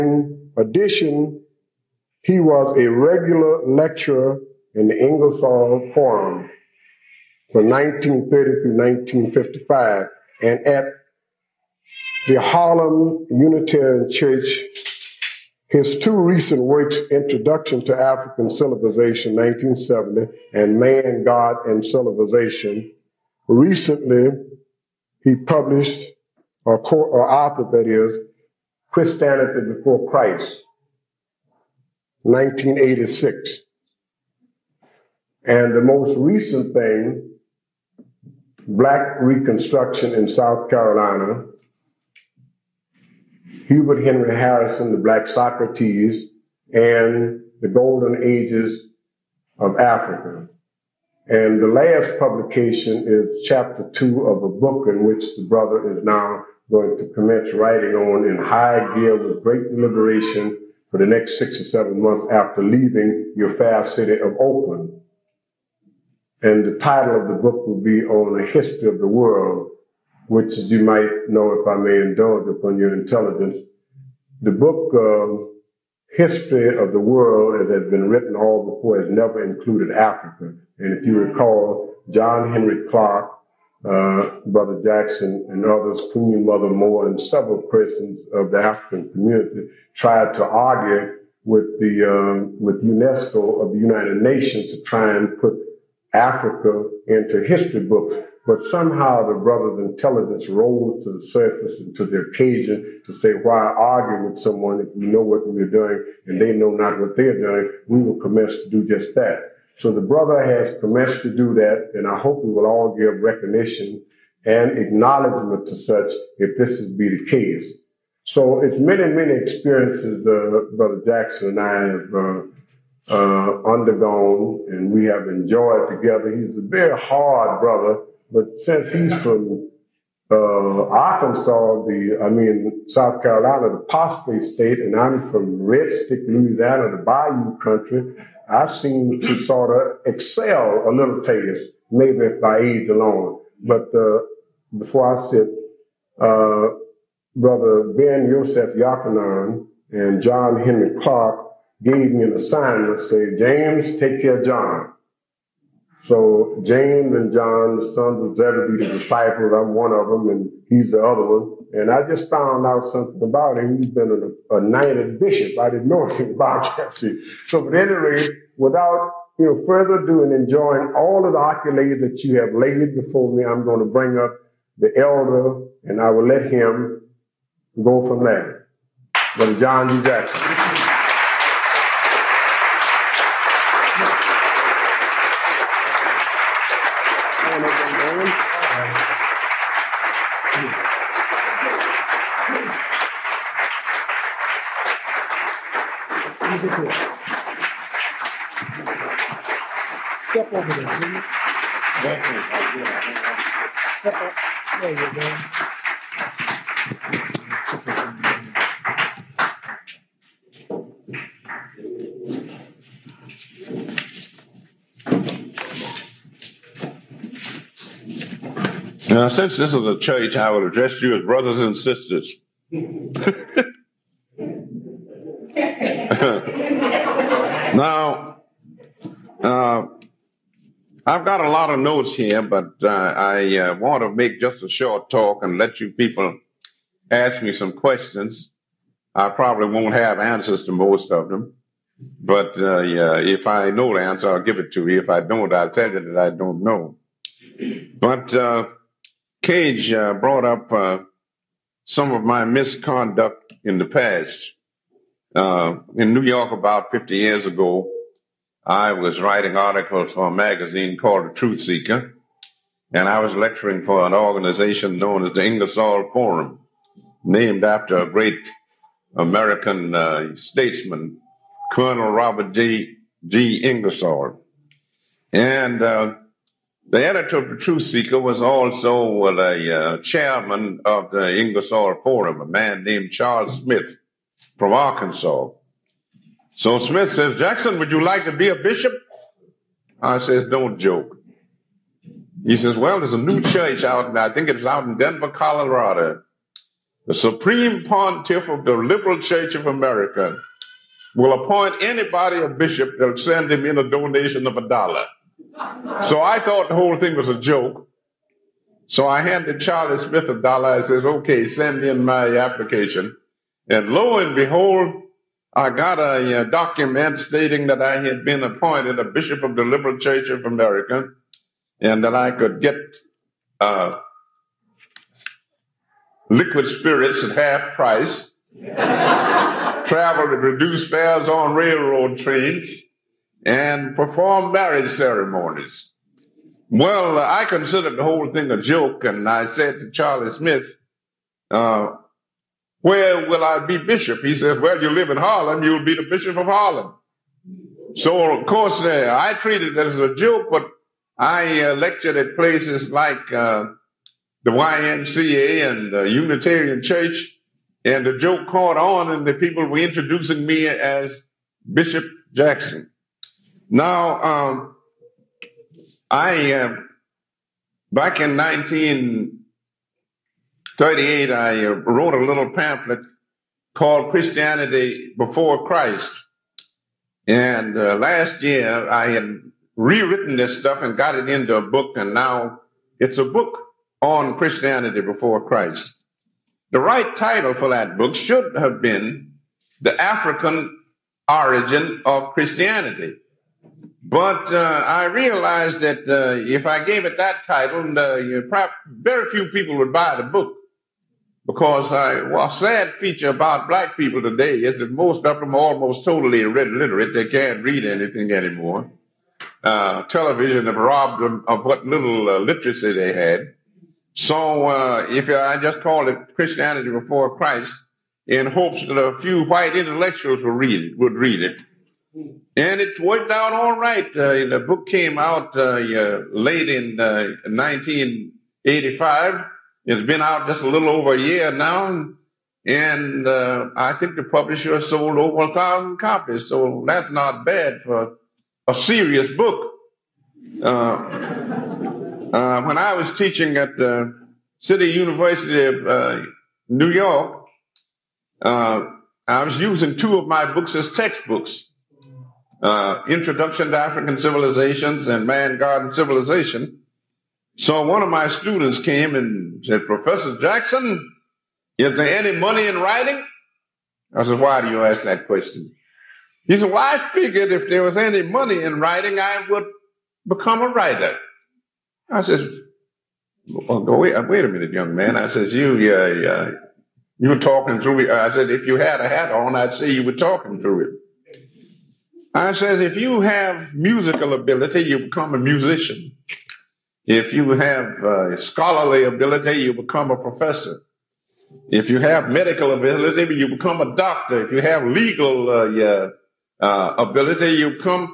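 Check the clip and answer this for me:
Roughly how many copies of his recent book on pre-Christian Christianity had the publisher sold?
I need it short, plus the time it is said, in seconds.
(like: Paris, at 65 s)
over 1000, at 435 s.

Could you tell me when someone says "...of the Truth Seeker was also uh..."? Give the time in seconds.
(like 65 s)
277 s.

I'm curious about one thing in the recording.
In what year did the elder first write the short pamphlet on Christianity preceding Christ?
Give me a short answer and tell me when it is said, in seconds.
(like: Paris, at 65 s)
1938, at 370 s.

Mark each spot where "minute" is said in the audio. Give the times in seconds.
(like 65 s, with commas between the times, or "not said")
474 s.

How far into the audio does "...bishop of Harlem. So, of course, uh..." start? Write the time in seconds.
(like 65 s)
346 s.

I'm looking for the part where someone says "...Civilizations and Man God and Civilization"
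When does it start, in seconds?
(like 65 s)
454 s.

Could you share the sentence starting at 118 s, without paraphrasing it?
So it's many, many experiences uh, Brother Jackson and I have uh, uh, undergone, and we have enjoyed together.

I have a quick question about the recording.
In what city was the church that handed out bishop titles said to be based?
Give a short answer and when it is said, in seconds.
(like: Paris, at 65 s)
Denver, at 294 s.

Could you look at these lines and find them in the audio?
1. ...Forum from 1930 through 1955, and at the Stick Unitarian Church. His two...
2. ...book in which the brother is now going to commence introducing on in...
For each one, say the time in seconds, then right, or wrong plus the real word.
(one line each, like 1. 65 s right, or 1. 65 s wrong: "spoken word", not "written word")
1. 5 s wrong: "Harlem", not "Stick"
2. 54 s wrong: "writing", not "introducing".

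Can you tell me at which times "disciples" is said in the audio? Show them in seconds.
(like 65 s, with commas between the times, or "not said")
158 s.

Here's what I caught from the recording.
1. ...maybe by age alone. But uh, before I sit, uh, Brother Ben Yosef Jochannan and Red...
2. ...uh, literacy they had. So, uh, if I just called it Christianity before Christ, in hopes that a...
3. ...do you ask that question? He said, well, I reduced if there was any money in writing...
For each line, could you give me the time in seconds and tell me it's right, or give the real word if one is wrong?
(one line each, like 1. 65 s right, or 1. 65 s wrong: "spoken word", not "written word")
1. 141 s wrong: "John", not "Red"
2. 412 s right
3. 464 s wrong: "figured", not "reduced".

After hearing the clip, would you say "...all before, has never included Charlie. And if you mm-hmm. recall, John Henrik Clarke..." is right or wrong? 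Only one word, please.
wrong.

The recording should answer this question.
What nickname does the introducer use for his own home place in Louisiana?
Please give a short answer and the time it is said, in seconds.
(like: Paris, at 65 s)
Red Stick, at 135 s.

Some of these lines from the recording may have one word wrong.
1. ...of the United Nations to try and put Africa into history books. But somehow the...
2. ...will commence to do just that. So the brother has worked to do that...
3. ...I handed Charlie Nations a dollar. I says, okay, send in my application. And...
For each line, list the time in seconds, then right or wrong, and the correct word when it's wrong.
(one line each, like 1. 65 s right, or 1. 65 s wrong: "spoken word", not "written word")
1. 93 s right
2. 108 s wrong: "commenced", not "worked"
3. 309 s wrong: "Smith", not "Nations".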